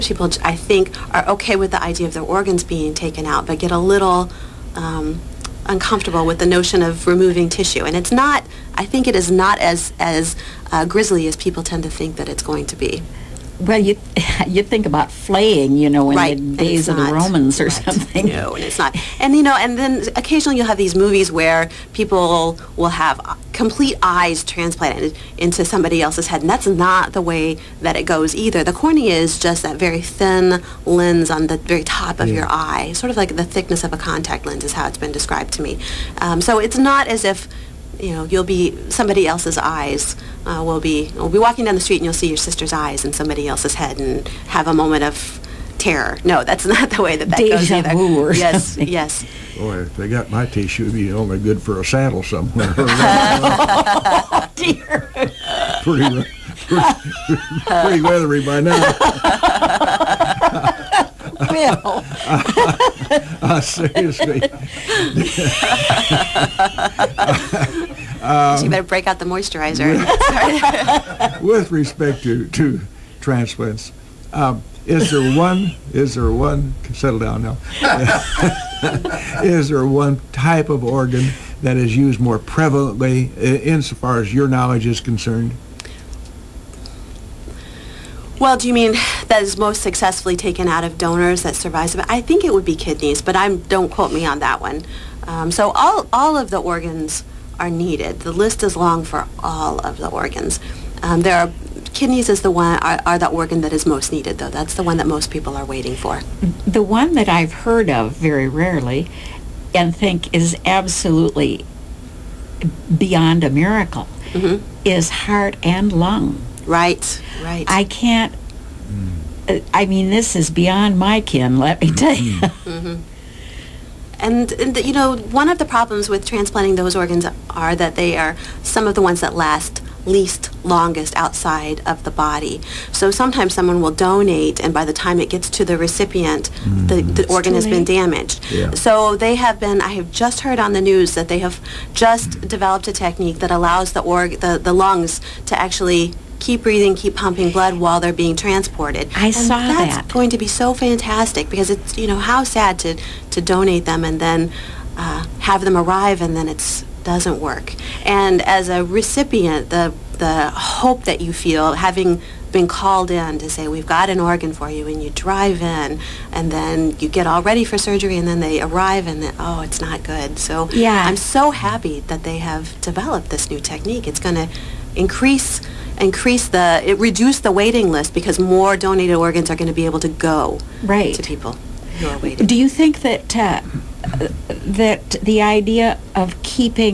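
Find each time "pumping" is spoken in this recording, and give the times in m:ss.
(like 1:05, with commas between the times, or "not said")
2:27.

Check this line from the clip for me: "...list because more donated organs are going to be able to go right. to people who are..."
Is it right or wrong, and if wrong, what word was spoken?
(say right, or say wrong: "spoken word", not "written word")
right.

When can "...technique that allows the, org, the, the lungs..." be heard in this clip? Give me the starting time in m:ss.
2:22.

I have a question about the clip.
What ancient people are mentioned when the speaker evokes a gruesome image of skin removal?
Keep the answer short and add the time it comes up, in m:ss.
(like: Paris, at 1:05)
the Romans, at 0:17.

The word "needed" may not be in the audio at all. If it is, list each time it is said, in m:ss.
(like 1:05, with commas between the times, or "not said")
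1:37, 1:44.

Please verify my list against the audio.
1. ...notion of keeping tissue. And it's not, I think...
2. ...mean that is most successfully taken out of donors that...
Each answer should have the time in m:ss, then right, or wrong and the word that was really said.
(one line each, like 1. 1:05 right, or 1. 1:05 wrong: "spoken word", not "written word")
1. 0:06 wrong: "removing", not "keeping"
2. 1:28 right.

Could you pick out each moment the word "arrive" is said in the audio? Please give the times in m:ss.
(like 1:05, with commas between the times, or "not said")
2:35, 2:48.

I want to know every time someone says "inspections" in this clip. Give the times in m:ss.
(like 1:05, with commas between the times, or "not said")
not said.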